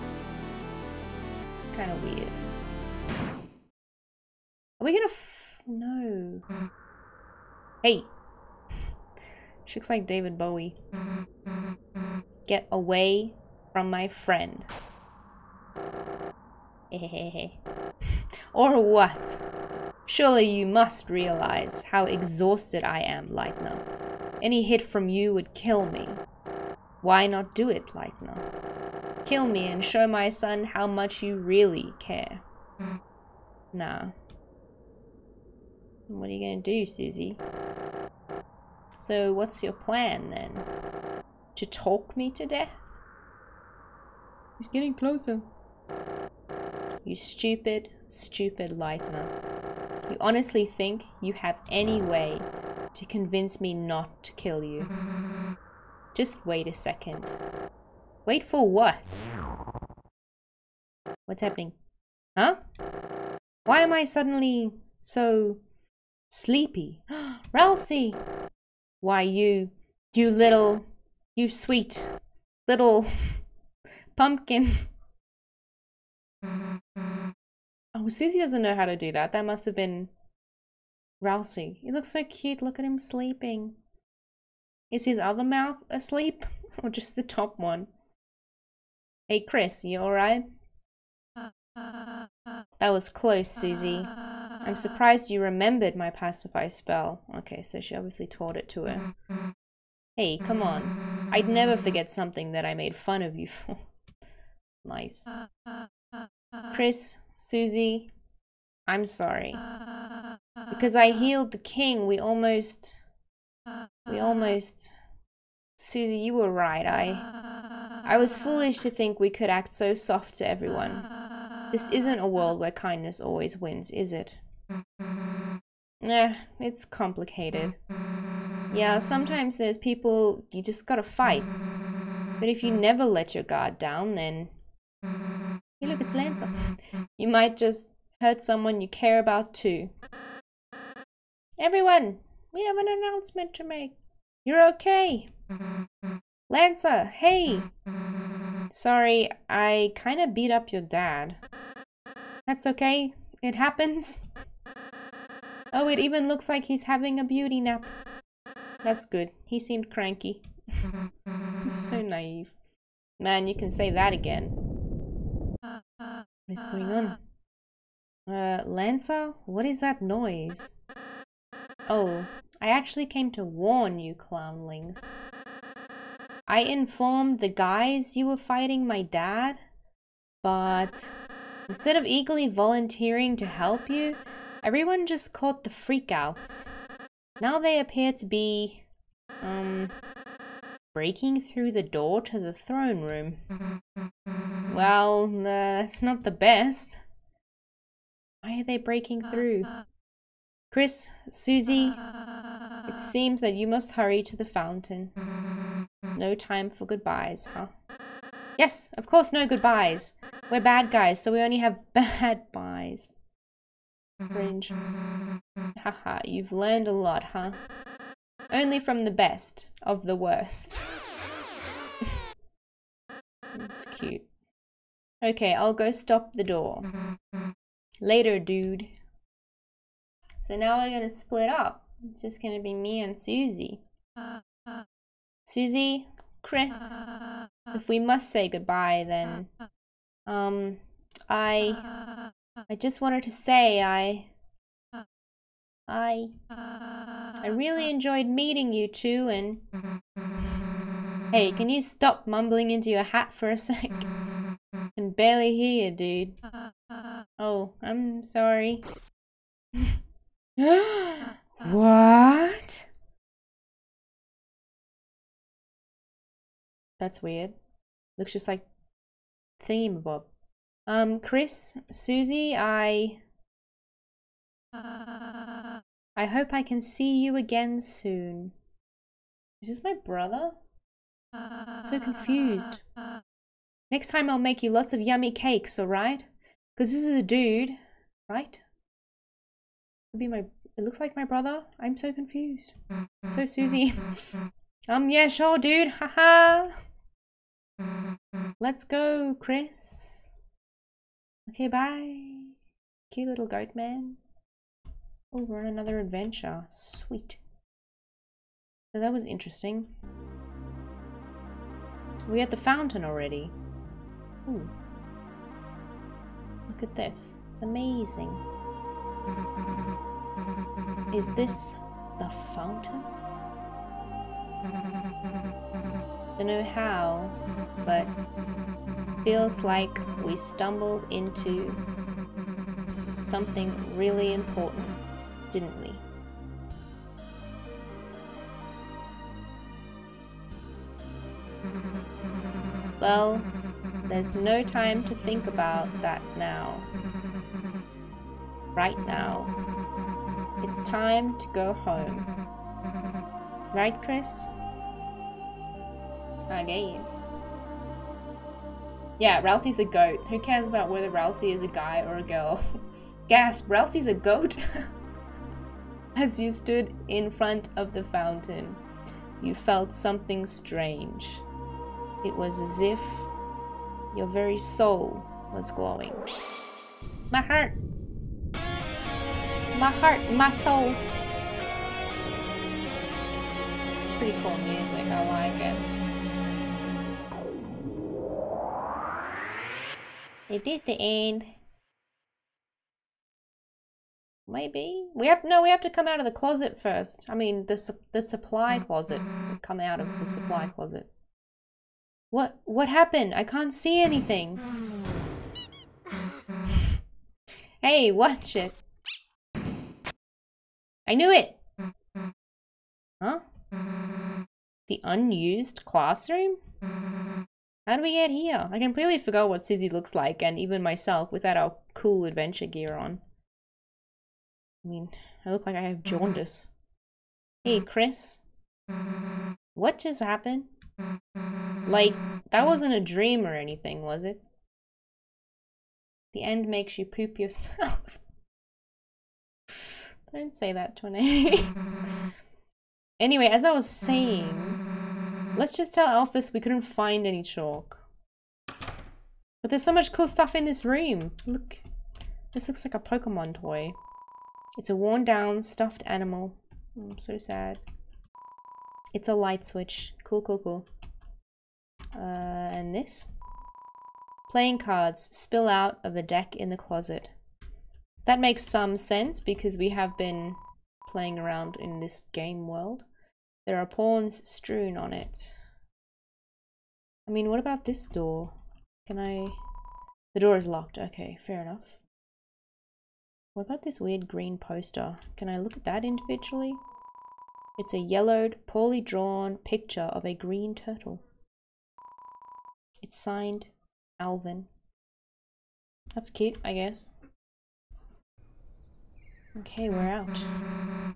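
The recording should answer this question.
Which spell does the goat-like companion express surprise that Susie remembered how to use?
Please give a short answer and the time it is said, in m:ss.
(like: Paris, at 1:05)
pacify spell, at 1:36.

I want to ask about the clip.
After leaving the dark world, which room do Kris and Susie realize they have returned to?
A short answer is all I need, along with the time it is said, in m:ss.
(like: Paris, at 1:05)
The unused classroom, at 6:54.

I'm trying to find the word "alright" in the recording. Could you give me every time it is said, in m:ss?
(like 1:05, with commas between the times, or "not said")
1:30, 4:45.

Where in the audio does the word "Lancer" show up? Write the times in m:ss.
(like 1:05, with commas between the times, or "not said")
2:16, 2:26, 2:48.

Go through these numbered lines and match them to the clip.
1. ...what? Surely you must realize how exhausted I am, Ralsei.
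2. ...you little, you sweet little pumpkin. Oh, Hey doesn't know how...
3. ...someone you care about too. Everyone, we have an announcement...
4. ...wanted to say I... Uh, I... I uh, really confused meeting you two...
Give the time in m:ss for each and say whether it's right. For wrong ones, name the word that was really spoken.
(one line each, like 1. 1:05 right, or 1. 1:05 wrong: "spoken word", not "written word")
1. 0:18 wrong: "Lightner", not "Ralsei"
2. 1:10 wrong: "Susie", not "Hey"
3. 2:18 right
4. 4:03 wrong: "enjoyed", not "confused".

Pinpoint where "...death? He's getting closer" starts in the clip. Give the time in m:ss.
0:42.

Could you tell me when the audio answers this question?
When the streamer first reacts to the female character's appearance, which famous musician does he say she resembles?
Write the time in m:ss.
0:10.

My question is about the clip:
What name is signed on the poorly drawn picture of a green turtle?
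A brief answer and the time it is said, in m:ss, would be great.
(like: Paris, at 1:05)
Alvin, at 8:14.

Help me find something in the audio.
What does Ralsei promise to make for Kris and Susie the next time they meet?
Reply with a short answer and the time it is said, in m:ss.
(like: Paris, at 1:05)
yummy cakes, at 4:45.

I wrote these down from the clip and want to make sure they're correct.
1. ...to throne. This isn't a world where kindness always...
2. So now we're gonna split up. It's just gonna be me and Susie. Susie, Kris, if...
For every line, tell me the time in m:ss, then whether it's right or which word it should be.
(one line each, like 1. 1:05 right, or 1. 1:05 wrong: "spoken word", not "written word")
1. 2:00 wrong: "everyone", not "throne"
2. 3:50 right.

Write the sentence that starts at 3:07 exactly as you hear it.
Now they appear to be, um, breaking through the door to the throne room.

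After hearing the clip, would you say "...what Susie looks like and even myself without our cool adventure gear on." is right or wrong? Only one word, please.
right.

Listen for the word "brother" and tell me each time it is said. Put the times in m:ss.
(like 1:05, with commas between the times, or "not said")
4:40, 4:51.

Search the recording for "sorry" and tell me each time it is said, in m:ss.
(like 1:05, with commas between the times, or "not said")
1:49, 2:28, 4:18.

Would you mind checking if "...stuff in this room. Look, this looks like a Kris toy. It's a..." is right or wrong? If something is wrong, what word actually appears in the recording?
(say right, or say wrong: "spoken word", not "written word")
wrong: "Pokemon", not "Kris".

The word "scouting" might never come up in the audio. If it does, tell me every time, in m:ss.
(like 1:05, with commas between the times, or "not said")
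not said.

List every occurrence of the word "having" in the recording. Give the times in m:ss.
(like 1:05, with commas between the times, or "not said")
2:36.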